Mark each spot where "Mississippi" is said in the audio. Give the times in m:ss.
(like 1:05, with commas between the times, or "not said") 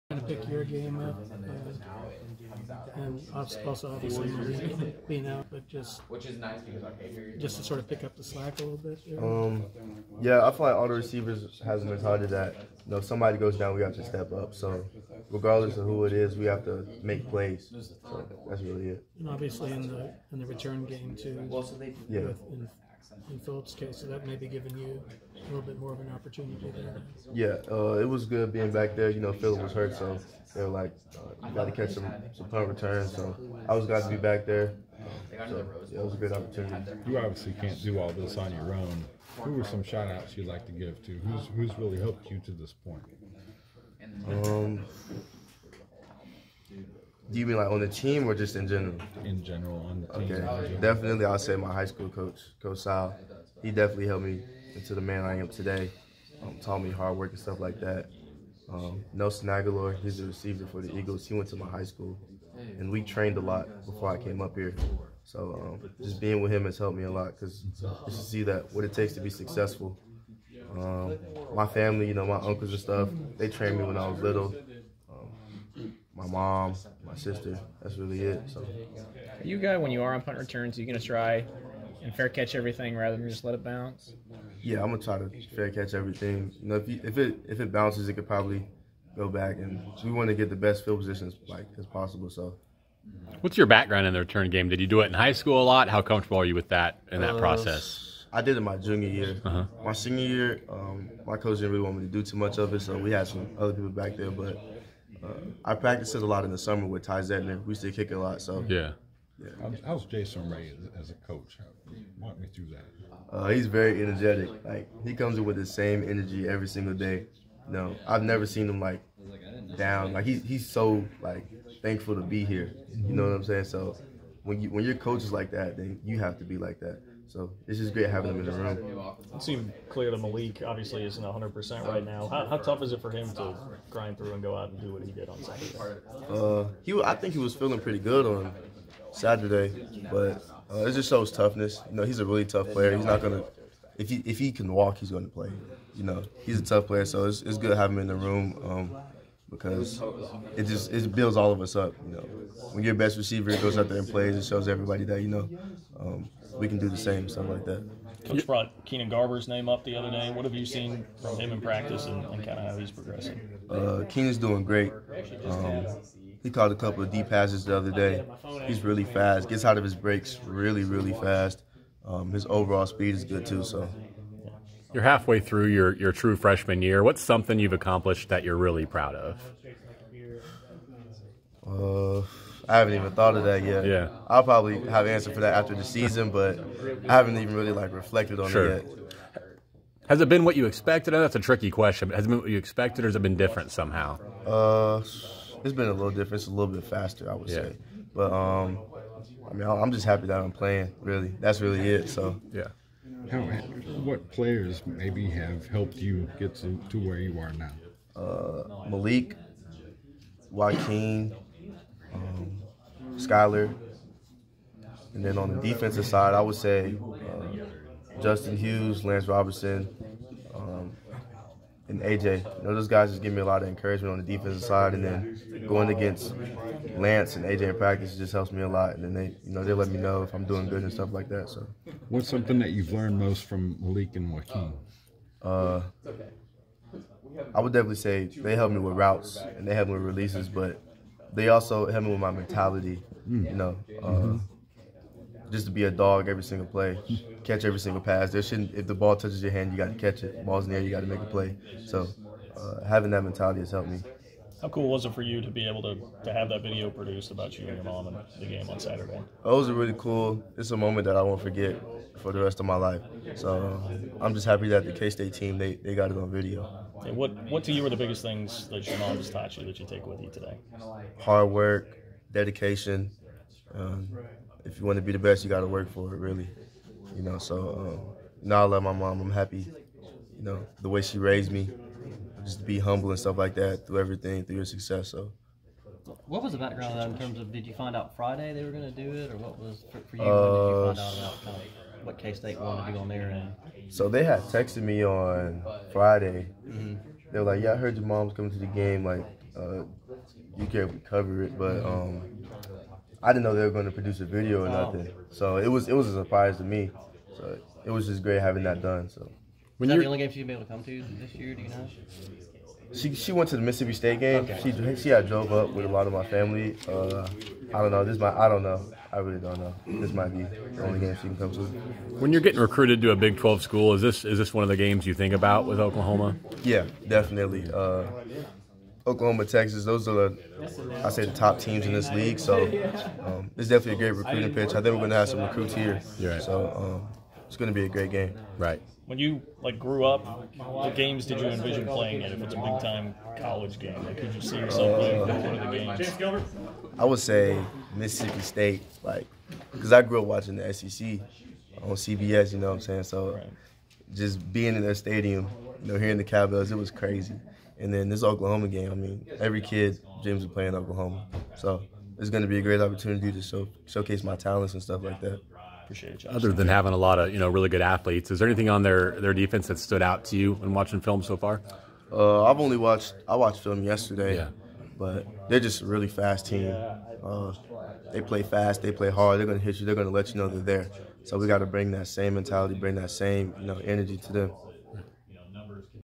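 5:13, 5:47.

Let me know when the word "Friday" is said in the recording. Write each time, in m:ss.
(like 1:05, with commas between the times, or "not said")
4:48, 4:55.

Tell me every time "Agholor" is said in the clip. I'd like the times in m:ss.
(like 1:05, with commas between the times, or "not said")
0:59.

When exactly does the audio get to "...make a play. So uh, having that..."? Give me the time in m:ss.
4:11.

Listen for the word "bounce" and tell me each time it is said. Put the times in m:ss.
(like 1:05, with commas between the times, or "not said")
1:23, 1:27.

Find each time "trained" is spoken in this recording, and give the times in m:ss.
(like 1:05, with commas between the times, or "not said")
1:03, 1:13.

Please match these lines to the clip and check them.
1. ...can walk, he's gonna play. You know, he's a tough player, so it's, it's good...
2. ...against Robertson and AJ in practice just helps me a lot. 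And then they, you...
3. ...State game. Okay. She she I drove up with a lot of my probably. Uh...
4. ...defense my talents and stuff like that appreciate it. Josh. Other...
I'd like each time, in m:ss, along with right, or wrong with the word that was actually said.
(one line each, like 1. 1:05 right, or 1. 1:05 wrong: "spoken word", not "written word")
1. 2:24 right
2. 3:45 wrong: "Lance", not "Robertson"
3. 5:13 wrong: "family", not "probably"
4. 6:03 wrong: "showcase", not "defense".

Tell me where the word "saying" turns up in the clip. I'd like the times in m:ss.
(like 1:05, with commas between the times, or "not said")
2:03, 5:52.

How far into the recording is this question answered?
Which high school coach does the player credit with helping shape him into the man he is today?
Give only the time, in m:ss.
0:52.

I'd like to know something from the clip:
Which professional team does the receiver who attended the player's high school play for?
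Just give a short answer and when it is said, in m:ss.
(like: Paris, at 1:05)
Eagles, at 1:00.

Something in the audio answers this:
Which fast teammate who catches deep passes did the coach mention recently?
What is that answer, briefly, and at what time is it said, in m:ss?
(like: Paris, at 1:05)
Keenan Garber, at 2:38.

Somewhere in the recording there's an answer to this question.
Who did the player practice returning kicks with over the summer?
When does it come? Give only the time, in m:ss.
1:47.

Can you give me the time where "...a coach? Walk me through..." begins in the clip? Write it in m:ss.
1:51.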